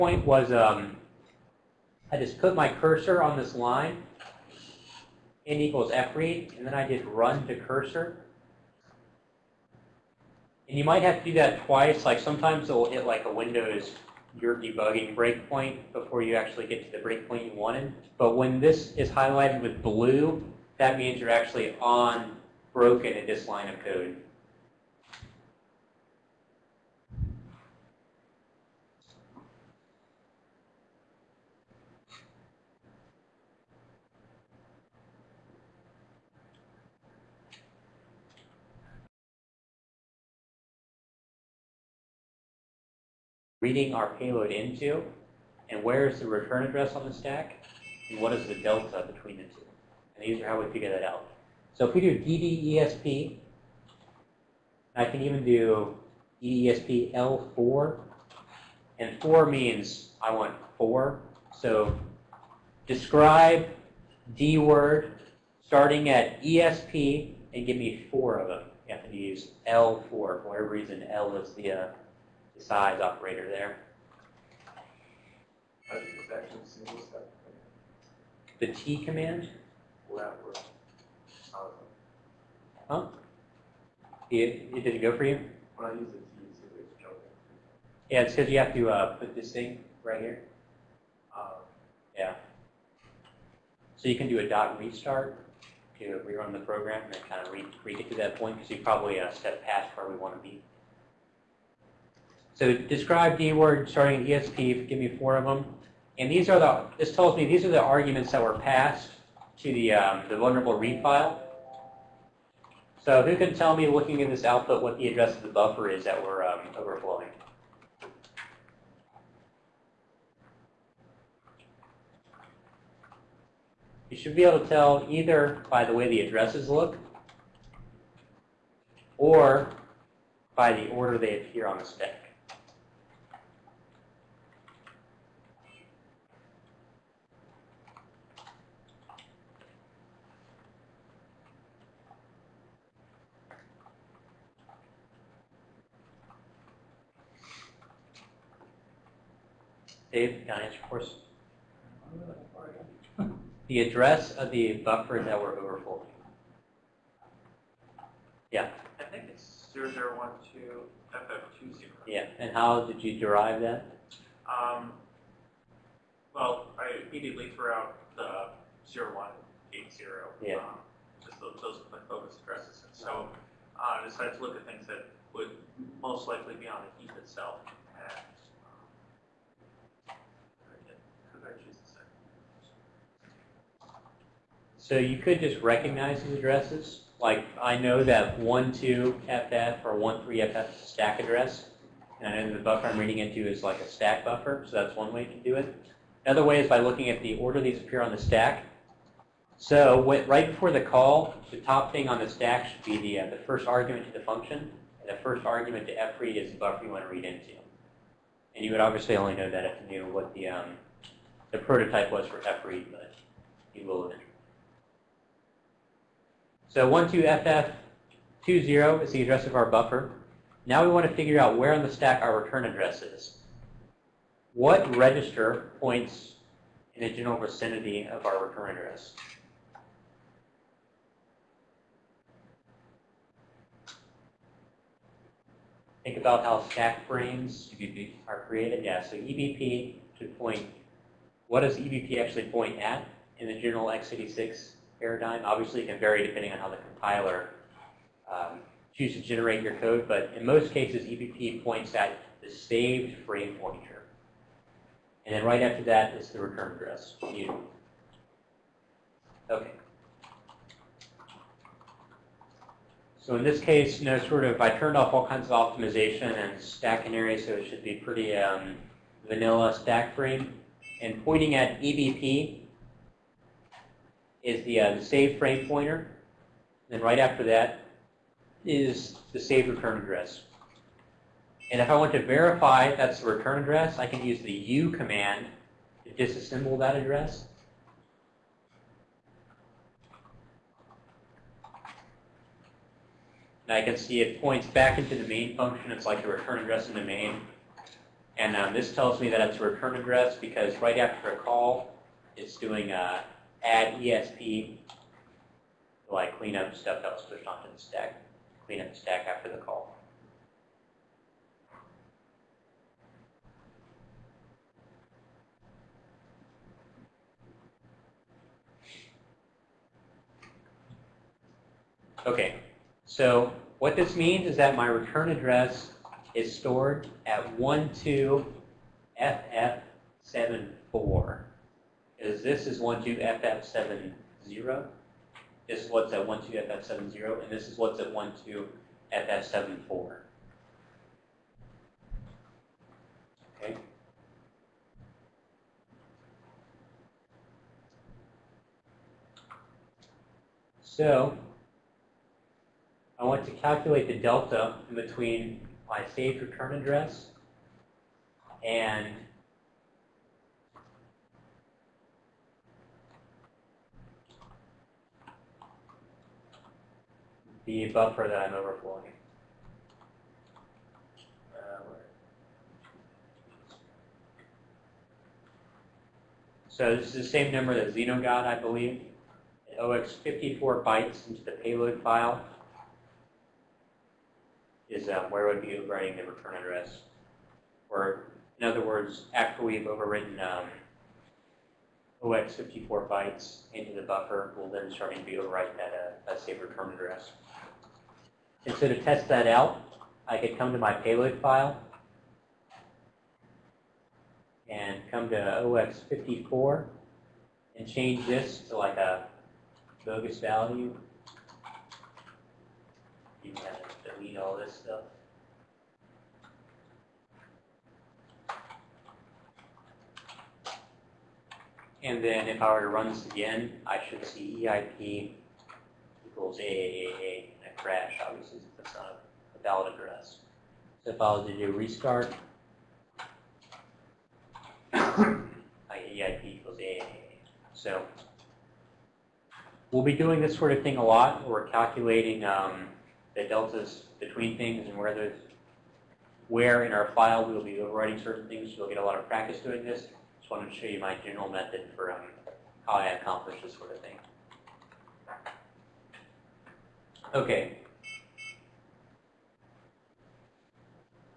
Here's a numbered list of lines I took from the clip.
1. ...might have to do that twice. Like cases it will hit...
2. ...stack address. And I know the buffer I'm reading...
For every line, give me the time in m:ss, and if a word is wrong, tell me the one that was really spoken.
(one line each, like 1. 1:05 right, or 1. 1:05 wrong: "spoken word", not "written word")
1. 0:10 wrong: "sometimes", not "cases"
2. 3:10 right.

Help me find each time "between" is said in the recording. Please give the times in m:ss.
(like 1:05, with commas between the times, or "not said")
0:49, 5:54, 7:24.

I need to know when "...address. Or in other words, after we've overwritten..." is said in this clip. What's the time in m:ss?
6:26.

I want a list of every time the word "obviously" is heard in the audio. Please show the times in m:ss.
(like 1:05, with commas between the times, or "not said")
3:28, 4:05, 7:08.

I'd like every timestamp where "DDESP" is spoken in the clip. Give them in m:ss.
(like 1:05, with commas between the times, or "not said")
0:52, 0:56.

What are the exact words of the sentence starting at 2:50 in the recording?
Um, just the, those are my focus addresses.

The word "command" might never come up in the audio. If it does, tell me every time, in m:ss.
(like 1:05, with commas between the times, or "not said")
1:19, 4:44.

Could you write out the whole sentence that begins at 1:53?
So who can tell me, looking in this output, what the address of the buffer is that we're um, overflowing?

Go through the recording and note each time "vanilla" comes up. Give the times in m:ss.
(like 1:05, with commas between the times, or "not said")
4:29.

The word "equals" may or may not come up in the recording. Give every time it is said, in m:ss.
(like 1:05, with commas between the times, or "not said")
0:05, 7:06, 7:16.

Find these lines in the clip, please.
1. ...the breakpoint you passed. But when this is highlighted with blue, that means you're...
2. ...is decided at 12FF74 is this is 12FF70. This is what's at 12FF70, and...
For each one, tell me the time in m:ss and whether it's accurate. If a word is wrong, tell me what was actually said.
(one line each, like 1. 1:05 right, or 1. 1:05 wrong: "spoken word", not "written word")
1. 0:16 wrong: "wanted", not "passed"
2. 5:26 wrong: "stored", not "decided".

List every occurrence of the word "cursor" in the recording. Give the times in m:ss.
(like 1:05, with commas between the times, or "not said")
0:02, 0:07.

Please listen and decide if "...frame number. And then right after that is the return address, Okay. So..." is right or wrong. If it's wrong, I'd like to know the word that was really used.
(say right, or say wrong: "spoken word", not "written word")
wrong: "pointer", not "number".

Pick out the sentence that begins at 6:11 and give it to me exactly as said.
Uh, so this is the same number that Xeno got, I believe.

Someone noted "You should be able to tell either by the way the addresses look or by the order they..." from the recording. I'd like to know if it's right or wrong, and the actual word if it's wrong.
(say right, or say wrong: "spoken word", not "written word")
right.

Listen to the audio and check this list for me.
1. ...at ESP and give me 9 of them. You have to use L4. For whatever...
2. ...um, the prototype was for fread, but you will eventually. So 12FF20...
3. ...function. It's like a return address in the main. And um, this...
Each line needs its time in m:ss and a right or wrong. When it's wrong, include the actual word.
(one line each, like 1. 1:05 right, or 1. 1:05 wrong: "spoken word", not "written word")
1. 1:06 wrong: "4", not "9"
2. 3:30 right
3. 4:55 right.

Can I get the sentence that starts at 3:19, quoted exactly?
So what, right before the call, the top thing on the stack should be the, uh, the first argument to the function.